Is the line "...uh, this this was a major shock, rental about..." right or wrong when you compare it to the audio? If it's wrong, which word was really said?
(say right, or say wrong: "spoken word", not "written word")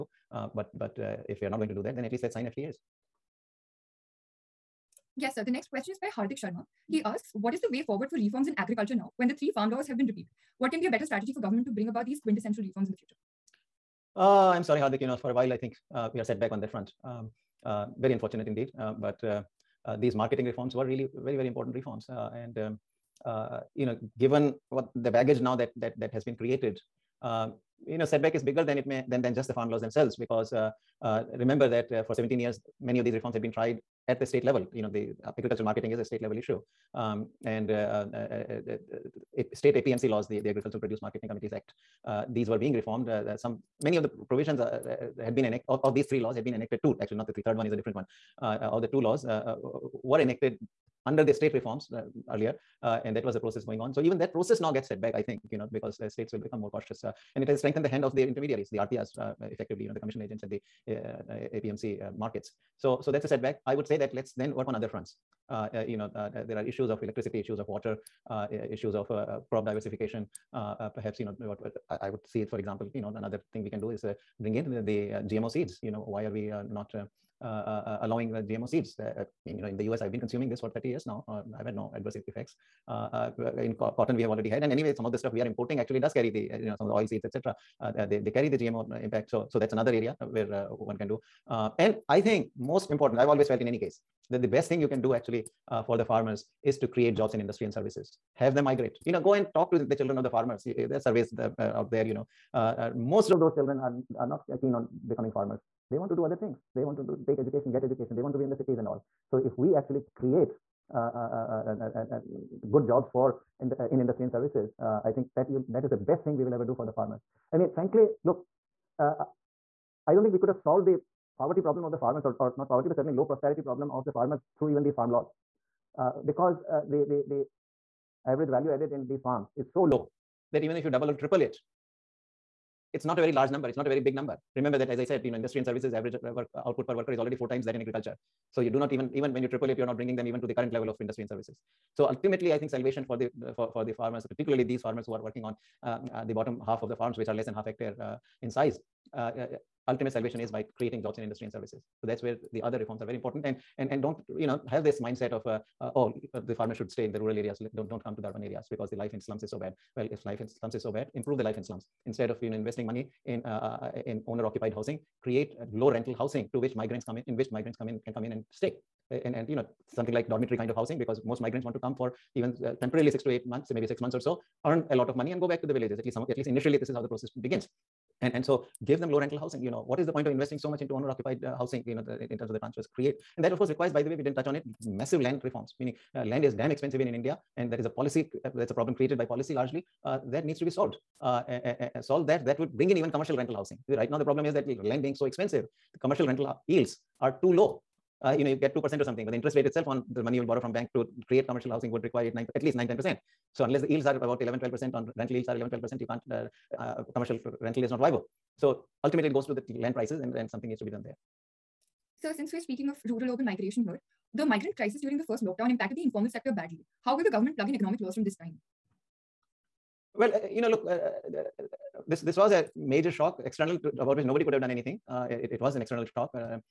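wrong: "external", not "rental".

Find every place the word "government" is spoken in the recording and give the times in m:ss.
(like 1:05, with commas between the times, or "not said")
0:11, 3:37.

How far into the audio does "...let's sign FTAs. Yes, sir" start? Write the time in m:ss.
0:02.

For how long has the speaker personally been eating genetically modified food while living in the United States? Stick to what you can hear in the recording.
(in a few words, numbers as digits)
30 years.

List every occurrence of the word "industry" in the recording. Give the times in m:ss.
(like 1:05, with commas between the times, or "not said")
1:37, 1:53, 2:15, 2:21, 2:31.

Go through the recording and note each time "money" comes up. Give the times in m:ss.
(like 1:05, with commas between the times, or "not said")
2:42, 2:55, 3:20.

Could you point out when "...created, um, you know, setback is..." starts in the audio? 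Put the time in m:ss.
0:26.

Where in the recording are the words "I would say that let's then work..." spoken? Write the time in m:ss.
1:03.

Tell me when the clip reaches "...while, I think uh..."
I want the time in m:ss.
0:15.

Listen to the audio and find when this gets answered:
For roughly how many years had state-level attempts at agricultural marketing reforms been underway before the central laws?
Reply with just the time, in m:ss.
0:32.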